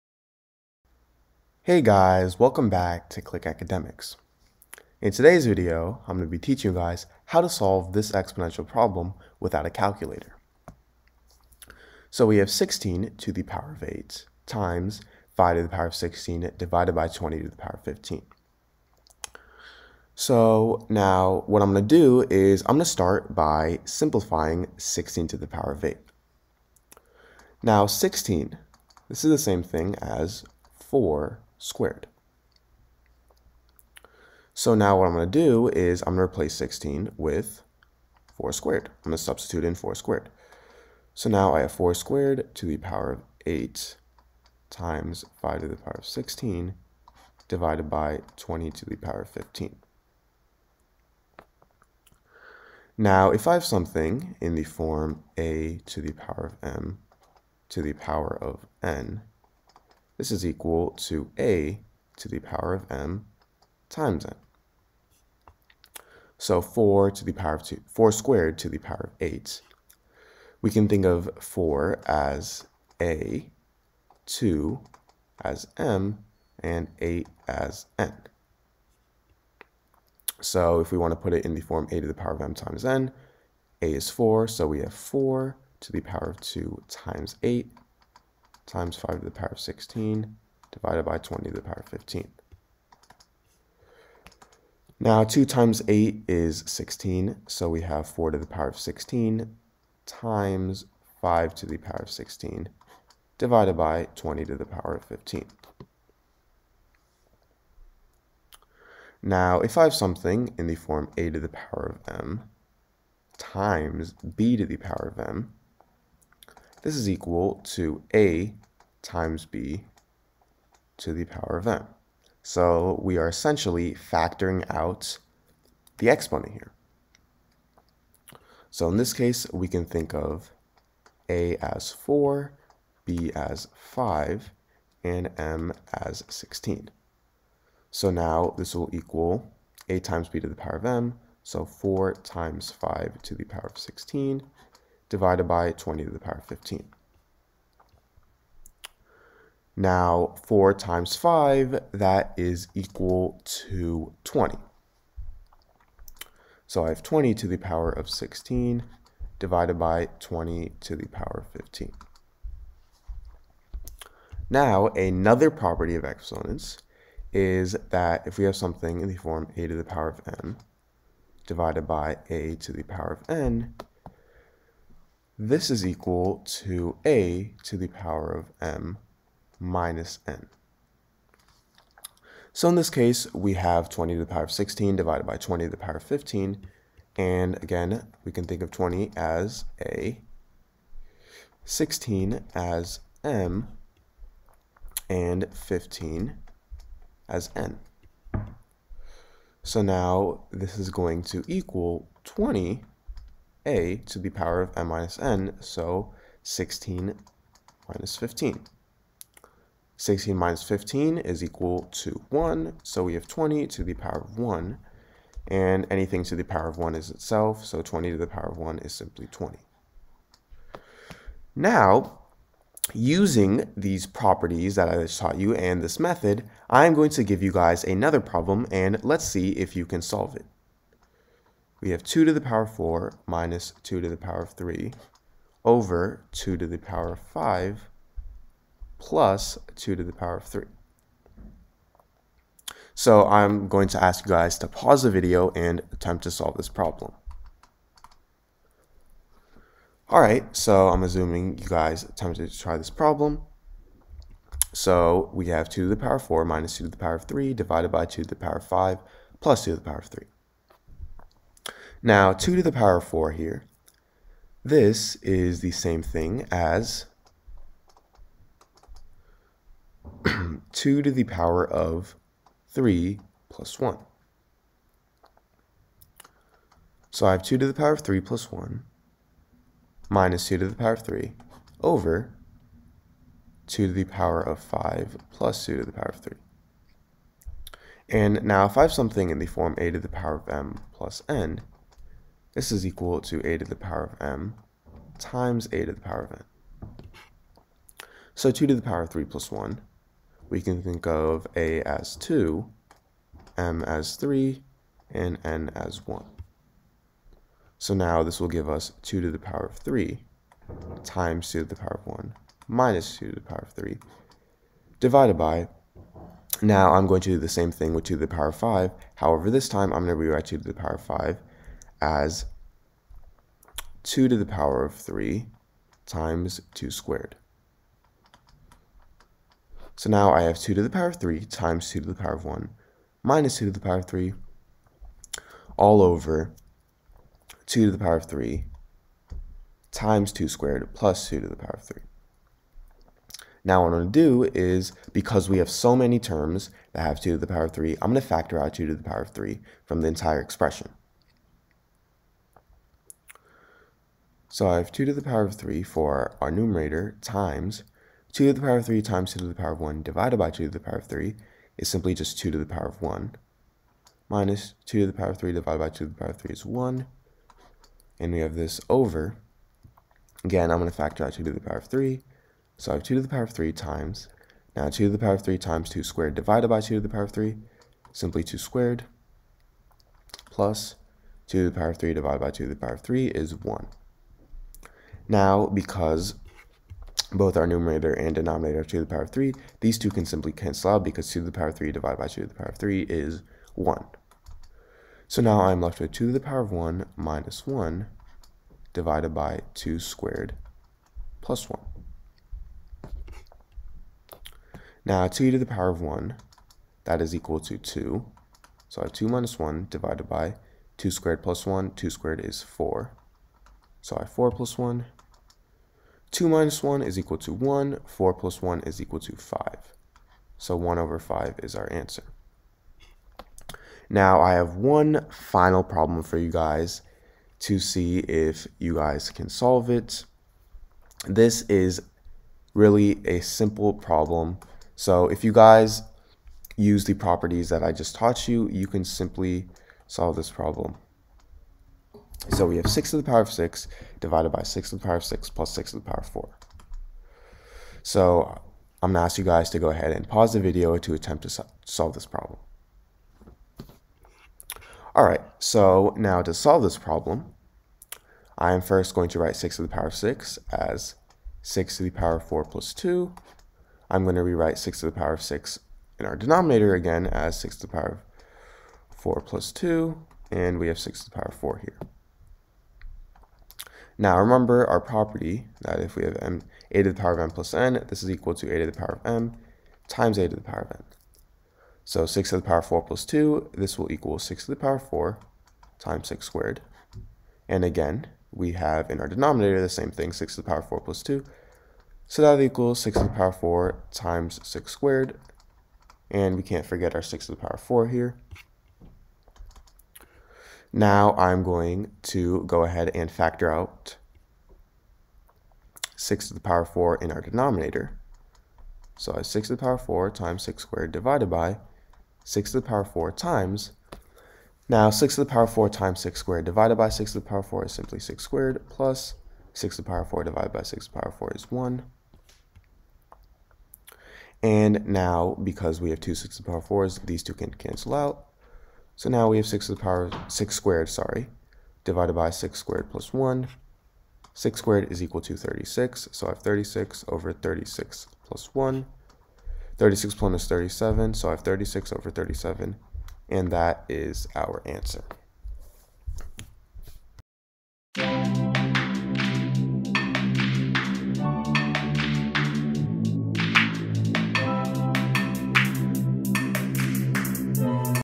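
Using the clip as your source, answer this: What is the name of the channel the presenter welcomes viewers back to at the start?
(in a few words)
Click Academics.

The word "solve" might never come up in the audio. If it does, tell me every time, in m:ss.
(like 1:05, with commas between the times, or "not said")
0:07, 3:50, 4:06, 7:09, 7:20, 7:31, 7:36.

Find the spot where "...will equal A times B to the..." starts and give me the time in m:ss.
2:18.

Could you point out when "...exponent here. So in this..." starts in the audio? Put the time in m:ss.
2:06.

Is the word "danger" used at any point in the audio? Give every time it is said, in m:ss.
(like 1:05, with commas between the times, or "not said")
not said.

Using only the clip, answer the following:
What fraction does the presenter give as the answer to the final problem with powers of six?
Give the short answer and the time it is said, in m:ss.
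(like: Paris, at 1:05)
36/37, at 9:01.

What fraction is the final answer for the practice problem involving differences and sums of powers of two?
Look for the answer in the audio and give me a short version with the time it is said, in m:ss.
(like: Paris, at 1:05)
1/5, at 7:00.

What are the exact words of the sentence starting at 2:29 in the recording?
Now, 4 times 5, that is equal to 20.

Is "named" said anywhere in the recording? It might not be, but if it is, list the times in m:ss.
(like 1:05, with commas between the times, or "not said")
not said.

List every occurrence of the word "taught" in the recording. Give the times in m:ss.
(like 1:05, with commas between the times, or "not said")
3:45, 7:18.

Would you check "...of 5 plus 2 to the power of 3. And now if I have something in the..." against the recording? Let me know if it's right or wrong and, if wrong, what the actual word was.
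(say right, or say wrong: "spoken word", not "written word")
right.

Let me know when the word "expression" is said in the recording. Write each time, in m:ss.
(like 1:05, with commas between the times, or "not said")
5:50.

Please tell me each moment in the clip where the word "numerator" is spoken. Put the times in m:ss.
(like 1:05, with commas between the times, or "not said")
5:56, 6:27.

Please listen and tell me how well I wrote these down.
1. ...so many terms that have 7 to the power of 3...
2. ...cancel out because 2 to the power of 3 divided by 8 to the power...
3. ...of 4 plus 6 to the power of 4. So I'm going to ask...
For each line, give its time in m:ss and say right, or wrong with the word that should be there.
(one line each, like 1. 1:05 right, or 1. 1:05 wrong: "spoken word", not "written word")
1. 5:45 wrong: "2", not "7"
2. 6:30 wrong: "2", not "8"
3. 7:25 wrong: "6", not "4".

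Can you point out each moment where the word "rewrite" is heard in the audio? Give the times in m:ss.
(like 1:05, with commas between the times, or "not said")
5:20, 7:44.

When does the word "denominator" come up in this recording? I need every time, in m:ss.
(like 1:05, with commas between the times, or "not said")
6:28, 7:46, 8:09, 8:27.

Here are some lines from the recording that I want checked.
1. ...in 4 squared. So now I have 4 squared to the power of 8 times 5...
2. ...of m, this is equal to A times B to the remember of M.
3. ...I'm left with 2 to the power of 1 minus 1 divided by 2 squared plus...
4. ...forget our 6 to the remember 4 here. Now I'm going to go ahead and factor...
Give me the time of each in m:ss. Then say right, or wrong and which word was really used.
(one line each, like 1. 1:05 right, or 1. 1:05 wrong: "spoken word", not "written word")
1. 0:39 right
2. 1:55 wrong: "power", not "remember"
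3. 6:35 right
4. 8:16 wrong: "power", not "remember".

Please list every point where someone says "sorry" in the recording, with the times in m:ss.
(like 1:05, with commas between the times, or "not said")
6:54, 8:51.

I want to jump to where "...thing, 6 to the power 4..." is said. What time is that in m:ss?
8:10.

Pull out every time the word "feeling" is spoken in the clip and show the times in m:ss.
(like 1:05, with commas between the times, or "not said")
not said.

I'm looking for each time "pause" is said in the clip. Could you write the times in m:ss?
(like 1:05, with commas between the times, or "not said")
4:04, 7:30.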